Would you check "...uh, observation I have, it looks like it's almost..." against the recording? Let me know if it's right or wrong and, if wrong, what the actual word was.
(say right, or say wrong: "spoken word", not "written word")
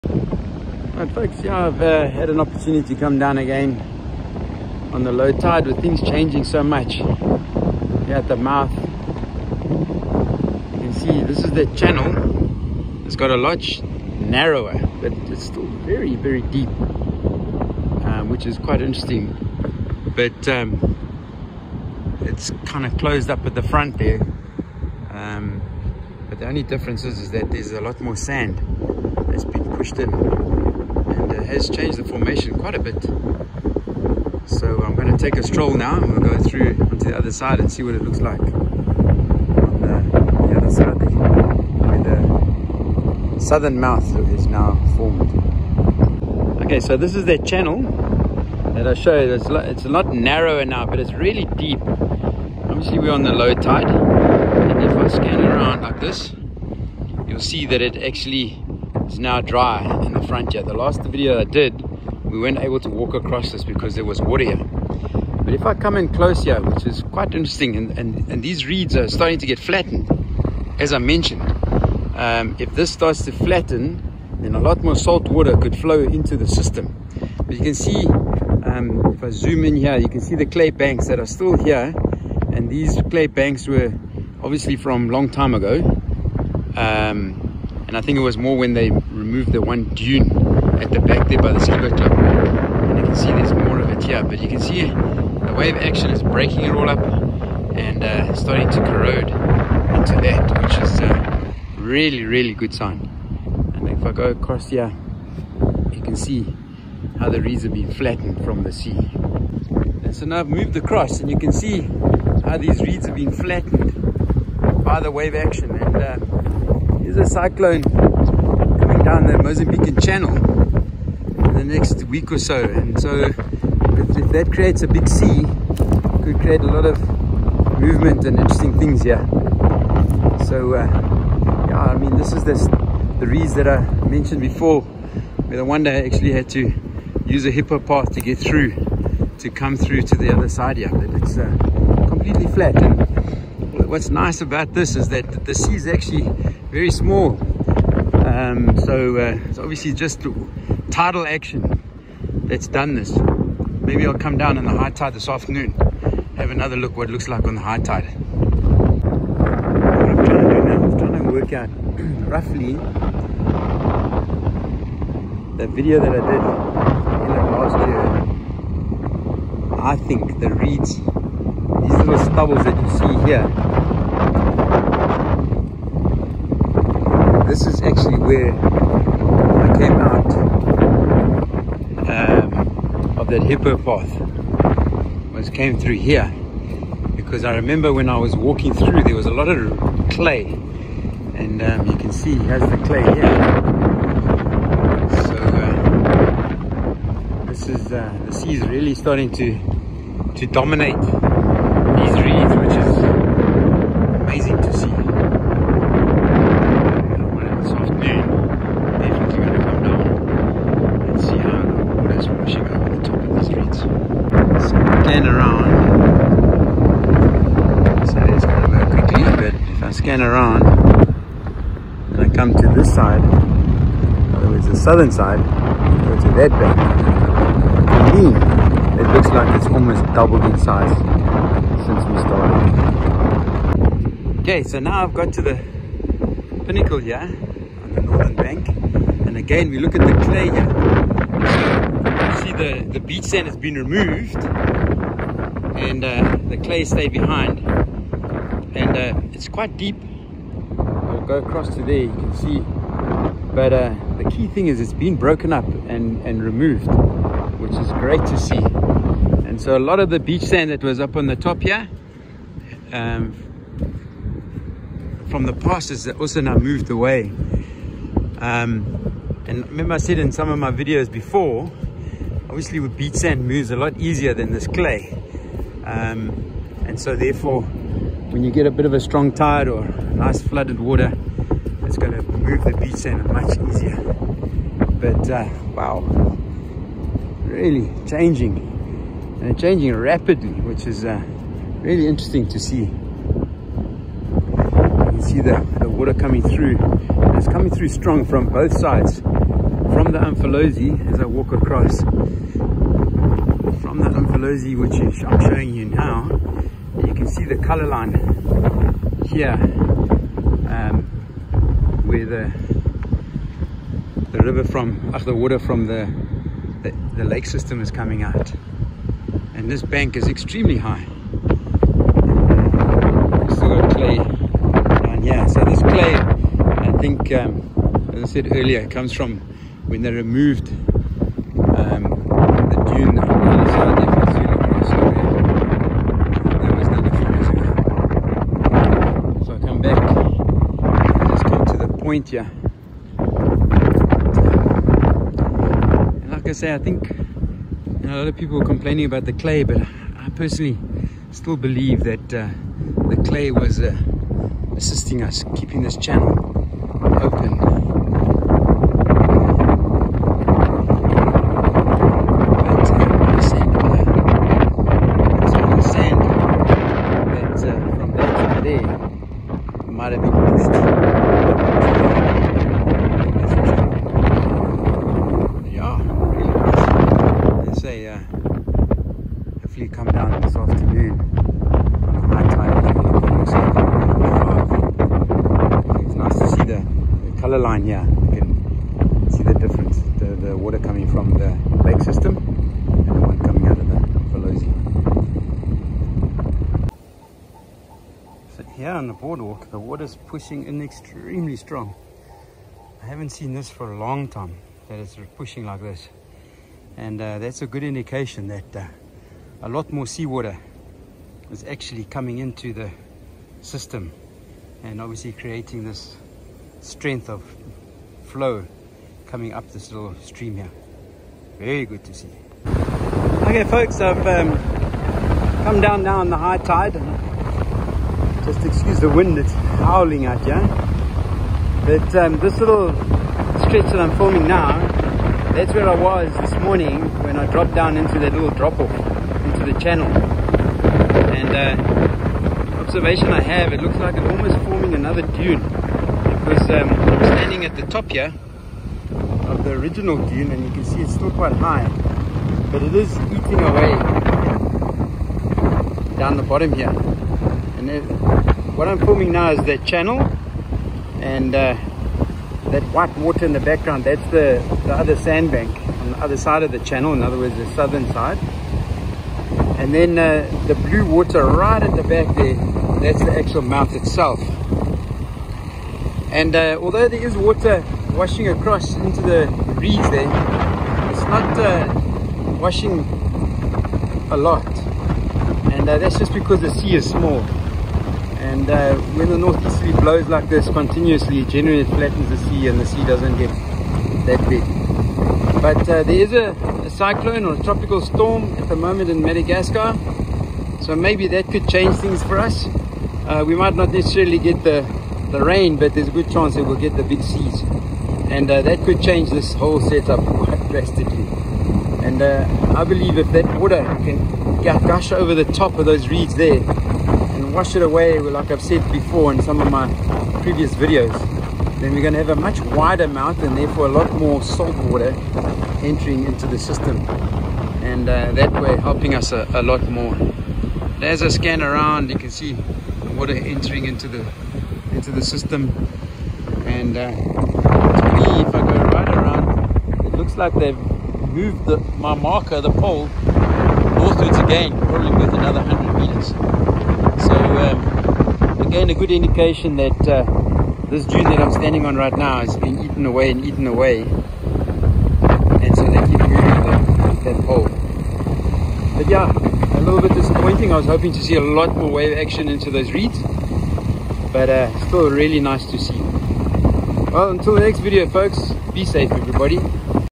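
right.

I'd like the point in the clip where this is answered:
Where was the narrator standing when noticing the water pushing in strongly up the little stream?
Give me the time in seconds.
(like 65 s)
399 s.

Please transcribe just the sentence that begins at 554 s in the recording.
And so they keep moving that, that pole.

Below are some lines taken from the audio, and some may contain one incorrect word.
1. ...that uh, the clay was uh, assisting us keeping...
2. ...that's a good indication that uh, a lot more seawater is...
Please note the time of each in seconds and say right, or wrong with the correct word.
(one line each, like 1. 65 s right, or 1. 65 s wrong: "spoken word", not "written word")
1. 352 s right
2. 407 s right.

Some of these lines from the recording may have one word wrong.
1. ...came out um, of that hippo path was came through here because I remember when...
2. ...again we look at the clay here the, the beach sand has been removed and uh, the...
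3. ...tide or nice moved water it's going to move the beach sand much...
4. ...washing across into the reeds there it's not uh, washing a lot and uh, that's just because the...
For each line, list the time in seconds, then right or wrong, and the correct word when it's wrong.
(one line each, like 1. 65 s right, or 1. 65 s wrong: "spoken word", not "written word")
1. 179 s right
2. 239 s right
3. 279 s wrong: "flooded", not "moved"
4. 478 s right.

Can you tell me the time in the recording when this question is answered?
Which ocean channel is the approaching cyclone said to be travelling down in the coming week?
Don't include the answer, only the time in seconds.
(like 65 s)
119 s.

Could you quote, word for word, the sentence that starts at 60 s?
The last video I did, we weren't able to walk across this because there was water here.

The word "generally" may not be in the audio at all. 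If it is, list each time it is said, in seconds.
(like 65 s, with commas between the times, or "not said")
491 s.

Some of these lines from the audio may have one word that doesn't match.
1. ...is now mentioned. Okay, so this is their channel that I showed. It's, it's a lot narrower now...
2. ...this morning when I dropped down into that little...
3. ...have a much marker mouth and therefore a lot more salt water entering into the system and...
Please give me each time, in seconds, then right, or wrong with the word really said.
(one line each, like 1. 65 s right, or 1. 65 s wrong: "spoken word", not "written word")
1. 44 s wrong: "formed", not "mentioned"
2. 436 s right
3. 522 s wrong: "wider", not "marker".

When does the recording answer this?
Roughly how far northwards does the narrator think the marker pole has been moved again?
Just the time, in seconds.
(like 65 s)
545 s.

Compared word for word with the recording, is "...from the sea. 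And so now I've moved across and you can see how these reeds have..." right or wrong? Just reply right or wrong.
right.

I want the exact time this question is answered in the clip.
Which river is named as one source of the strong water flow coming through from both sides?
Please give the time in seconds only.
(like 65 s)
300 s.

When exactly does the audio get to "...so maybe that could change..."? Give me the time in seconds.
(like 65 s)
500 s.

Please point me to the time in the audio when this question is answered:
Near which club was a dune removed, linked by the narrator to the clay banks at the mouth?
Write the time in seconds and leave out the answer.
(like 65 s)
91 s.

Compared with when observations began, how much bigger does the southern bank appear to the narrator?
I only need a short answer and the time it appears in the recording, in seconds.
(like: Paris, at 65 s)
Almost doubled, at 229 s.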